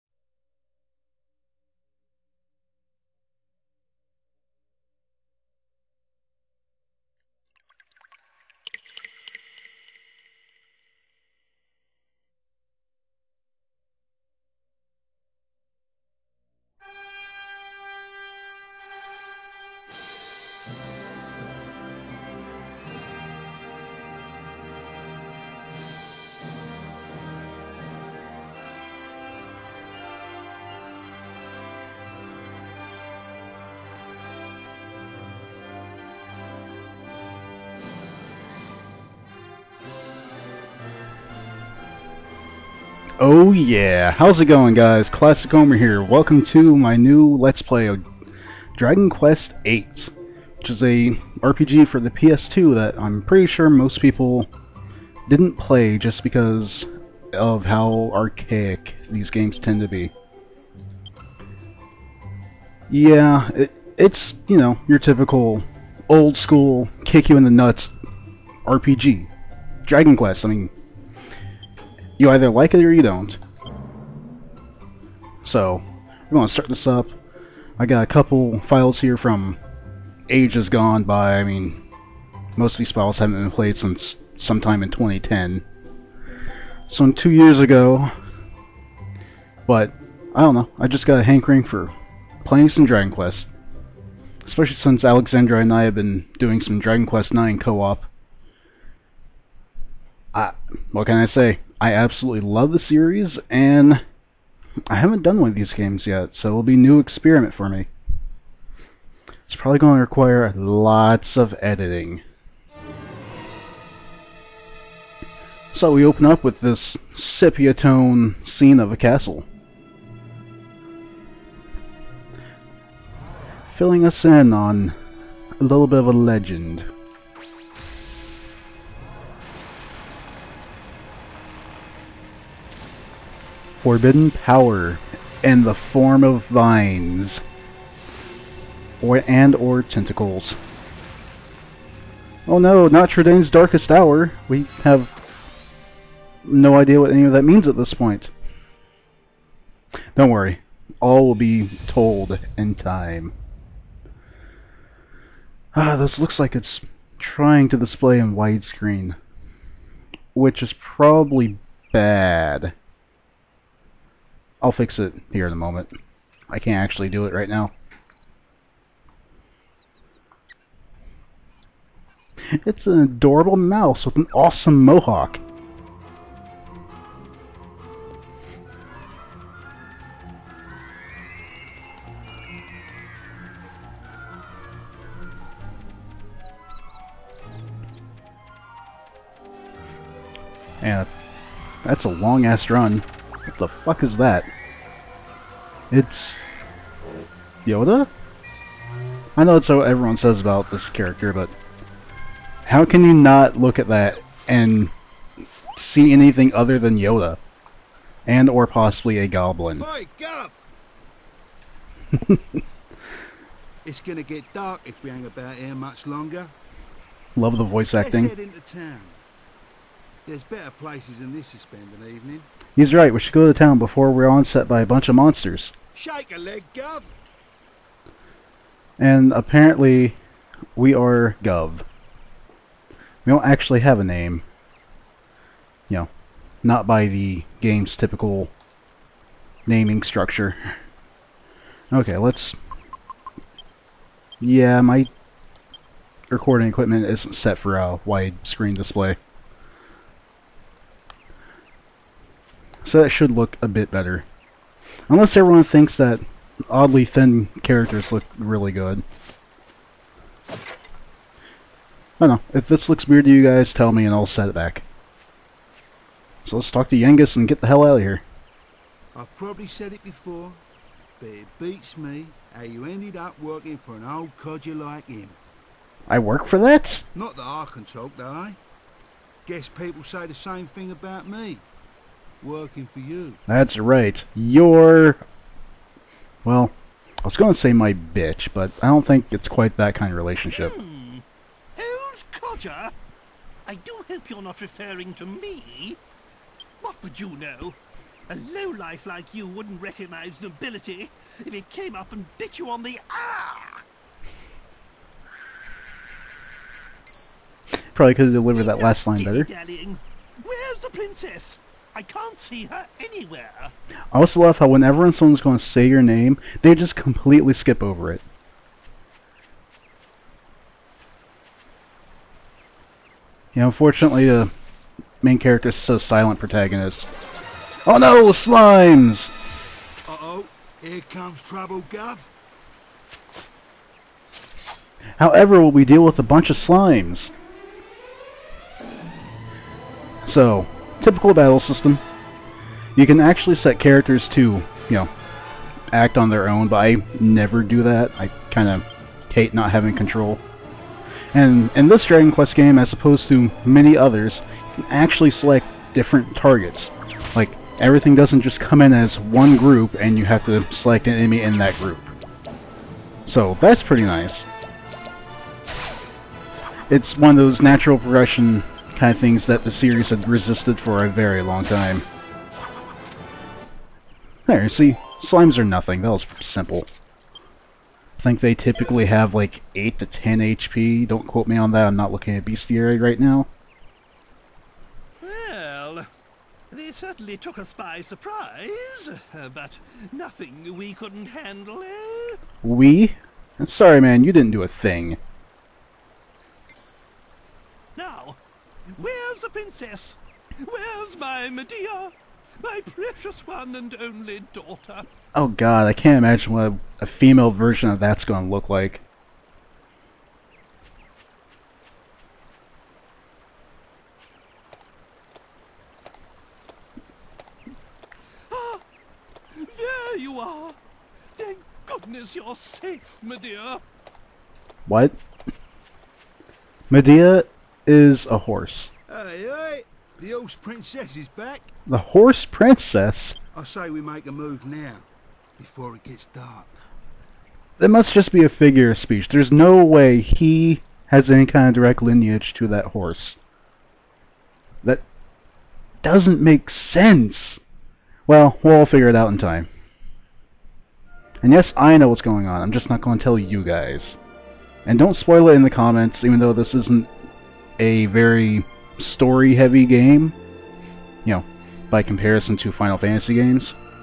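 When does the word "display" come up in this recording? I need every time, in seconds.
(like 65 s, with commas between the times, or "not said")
157 s, 248 s.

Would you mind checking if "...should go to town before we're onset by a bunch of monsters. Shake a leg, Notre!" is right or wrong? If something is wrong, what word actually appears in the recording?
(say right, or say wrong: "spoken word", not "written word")
wrong: "Guv", not "Notre".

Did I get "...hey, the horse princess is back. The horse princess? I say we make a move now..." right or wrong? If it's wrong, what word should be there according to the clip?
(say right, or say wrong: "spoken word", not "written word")
right.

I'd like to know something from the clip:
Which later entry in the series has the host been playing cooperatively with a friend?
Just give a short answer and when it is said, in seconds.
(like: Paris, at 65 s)
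Dragon Quest 9, at 96 s.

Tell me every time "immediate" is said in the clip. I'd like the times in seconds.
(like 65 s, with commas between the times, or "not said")
not said.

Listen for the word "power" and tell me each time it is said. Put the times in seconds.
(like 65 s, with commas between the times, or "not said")
134 s.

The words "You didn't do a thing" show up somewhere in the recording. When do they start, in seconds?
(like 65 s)
394 s.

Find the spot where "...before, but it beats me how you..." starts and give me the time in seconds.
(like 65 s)
270 s.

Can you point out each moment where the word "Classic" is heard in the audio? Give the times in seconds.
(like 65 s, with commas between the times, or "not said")
45 s.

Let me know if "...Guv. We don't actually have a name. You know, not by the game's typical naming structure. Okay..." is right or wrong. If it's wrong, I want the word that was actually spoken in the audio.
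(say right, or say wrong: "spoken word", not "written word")
right.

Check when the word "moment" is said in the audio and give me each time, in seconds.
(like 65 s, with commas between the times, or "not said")
165 s.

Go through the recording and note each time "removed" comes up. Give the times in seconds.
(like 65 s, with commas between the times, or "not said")
not said.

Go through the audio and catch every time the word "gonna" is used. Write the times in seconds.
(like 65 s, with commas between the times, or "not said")
214 s, 408 s.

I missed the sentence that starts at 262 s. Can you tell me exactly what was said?
If this looks weird to you guys, tell me and I'll set it back.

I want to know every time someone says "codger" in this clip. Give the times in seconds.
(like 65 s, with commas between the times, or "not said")
274 s, 292 s.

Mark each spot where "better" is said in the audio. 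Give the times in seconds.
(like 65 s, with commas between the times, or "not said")
220 s, 253 s, 309 s.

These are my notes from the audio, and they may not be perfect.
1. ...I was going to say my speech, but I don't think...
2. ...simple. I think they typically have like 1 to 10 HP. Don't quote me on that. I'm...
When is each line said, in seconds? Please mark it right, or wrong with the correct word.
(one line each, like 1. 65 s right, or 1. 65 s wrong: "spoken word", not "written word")
1. 287 s wrong: "bitch", not "speech"
2. 376 s wrong: "8", not "1".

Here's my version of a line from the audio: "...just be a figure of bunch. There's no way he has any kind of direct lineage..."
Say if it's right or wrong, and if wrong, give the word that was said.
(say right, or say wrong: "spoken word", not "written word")
wrong: "speech", not "bunch".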